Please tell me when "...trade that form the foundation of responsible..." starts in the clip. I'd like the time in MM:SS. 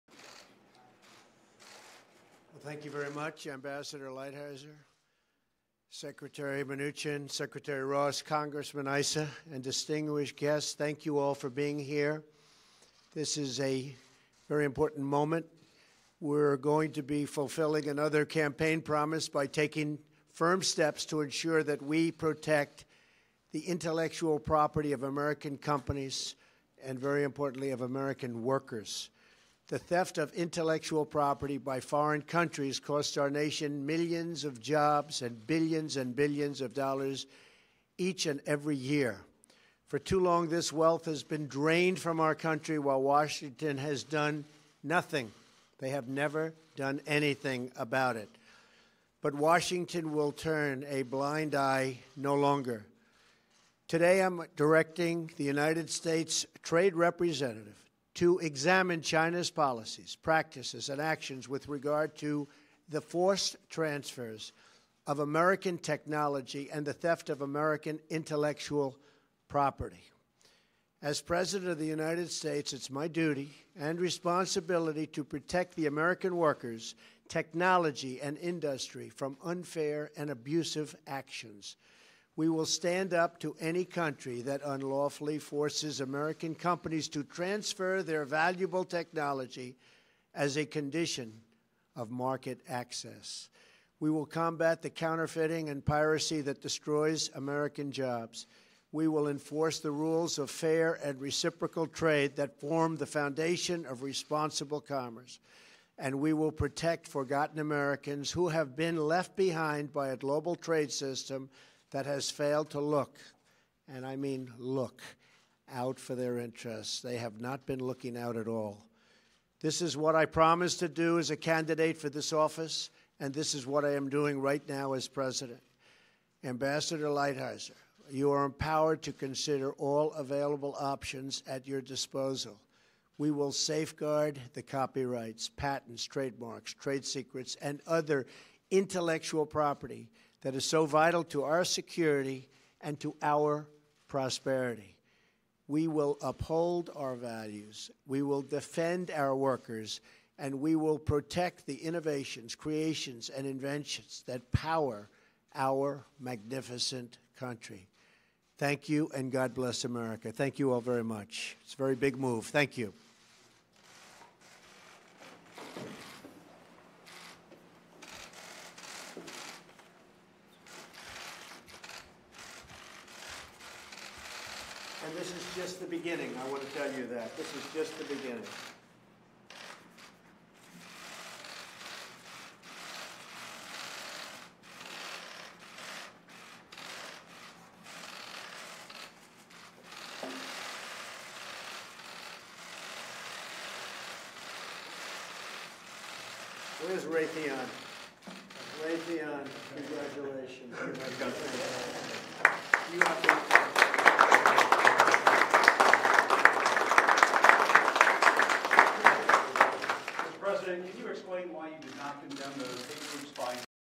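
01:41.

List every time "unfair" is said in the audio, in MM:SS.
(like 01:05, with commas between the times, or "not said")
01:19.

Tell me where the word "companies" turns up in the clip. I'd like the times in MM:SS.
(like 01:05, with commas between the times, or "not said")
00:25, 01:26.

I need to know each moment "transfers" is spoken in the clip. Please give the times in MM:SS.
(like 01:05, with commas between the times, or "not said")
01:03, 01:27.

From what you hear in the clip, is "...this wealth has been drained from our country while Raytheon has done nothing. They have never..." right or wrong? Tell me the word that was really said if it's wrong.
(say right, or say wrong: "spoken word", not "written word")
wrong: "Washington", not "Raytheon".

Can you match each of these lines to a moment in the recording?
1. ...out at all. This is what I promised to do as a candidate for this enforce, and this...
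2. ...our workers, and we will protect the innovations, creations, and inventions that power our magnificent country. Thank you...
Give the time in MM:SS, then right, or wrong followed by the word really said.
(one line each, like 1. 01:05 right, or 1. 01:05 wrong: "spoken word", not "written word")
1. 01:58 wrong: "office", not "enforce"
2. 02:29 right.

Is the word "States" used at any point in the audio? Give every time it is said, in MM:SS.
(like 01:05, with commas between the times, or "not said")
00:55, 01:12.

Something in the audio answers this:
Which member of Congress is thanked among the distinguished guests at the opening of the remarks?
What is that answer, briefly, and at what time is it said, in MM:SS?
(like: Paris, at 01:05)
Congressman Issa, at 00:08.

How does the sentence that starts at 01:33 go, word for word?
We will combat the counterfeiting and piracy that destroys American jobs.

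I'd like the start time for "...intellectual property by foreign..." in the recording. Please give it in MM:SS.
00:30.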